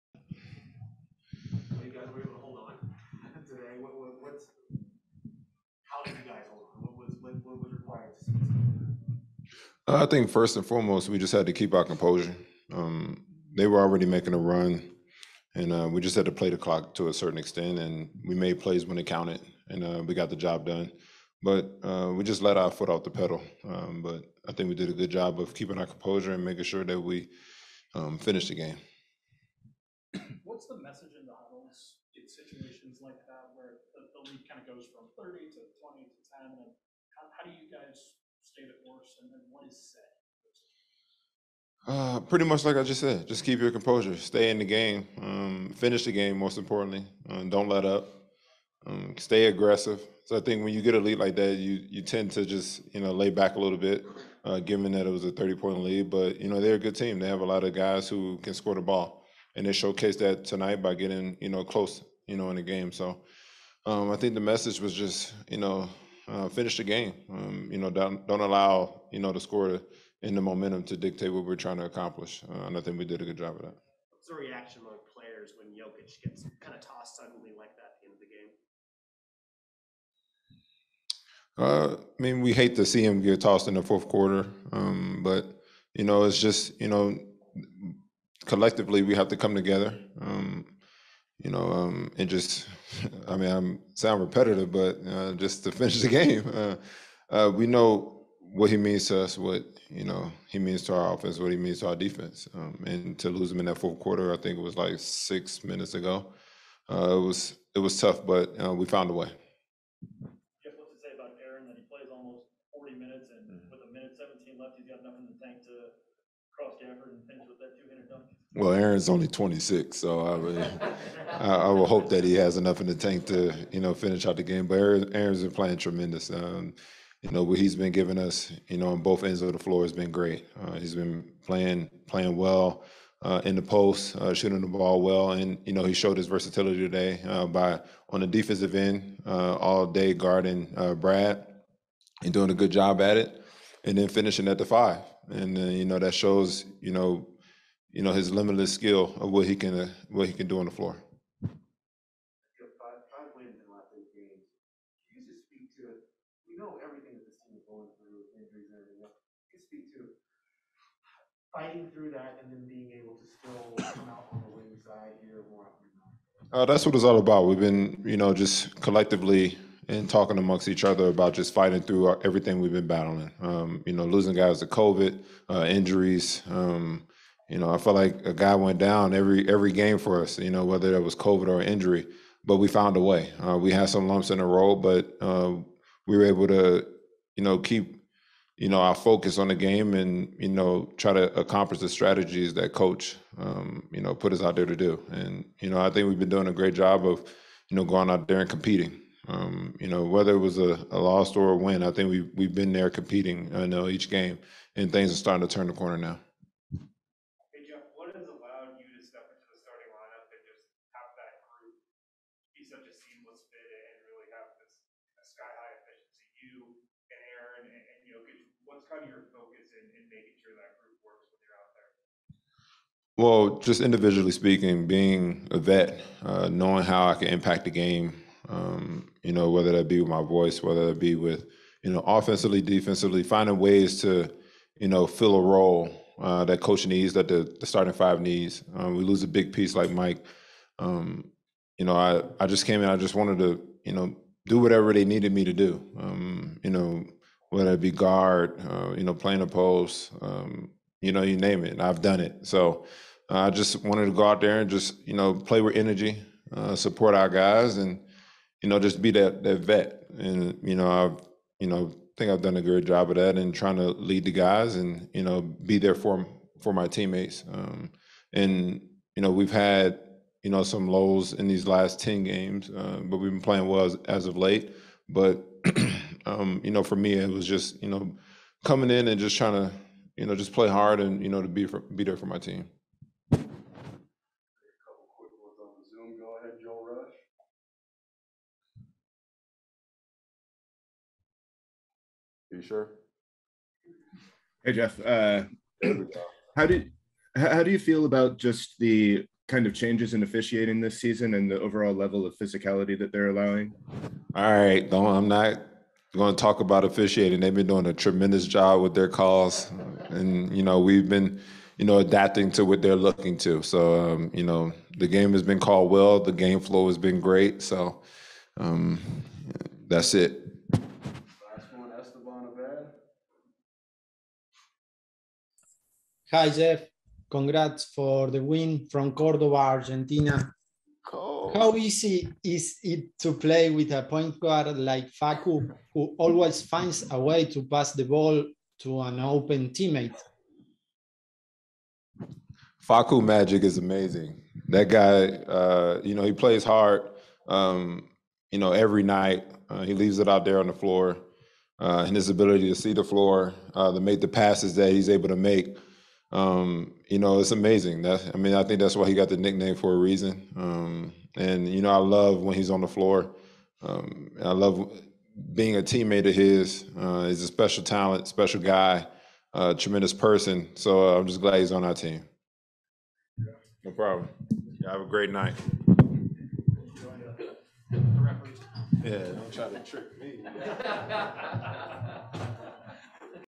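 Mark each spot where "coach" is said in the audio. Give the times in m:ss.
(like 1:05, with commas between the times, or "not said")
3:12, 3:56.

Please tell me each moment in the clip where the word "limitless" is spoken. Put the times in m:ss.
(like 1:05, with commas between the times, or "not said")
2:28.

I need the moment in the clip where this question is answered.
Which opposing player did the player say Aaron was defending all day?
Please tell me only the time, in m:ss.
2:20.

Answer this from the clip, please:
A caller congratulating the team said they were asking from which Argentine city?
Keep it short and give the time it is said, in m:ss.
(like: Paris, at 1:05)
Cordoba, at 5:29.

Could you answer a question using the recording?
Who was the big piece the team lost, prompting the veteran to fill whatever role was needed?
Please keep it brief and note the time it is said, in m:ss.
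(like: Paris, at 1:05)
Mike, at 3:59.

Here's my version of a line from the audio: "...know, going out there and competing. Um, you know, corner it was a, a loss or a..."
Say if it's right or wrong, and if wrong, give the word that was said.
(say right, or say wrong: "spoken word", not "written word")
wrong: "whether", not "corner".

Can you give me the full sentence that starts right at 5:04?
All right, don't I'm not going to talk about officiating.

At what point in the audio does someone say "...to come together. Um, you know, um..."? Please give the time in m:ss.
1:29.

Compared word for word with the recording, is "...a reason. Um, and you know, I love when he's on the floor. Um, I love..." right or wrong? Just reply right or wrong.
right.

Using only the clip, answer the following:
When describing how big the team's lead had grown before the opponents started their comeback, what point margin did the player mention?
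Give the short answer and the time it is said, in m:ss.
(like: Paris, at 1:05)
30, at 0:55.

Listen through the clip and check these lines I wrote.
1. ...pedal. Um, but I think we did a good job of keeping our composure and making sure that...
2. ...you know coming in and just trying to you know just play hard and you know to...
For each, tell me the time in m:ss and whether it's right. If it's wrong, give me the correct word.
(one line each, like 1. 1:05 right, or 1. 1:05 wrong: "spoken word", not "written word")
1. 0:23 right
2. 4:37 right.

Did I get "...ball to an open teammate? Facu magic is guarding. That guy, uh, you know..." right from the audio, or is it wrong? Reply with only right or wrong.
wrong.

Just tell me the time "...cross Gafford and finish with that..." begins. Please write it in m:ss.
1:56.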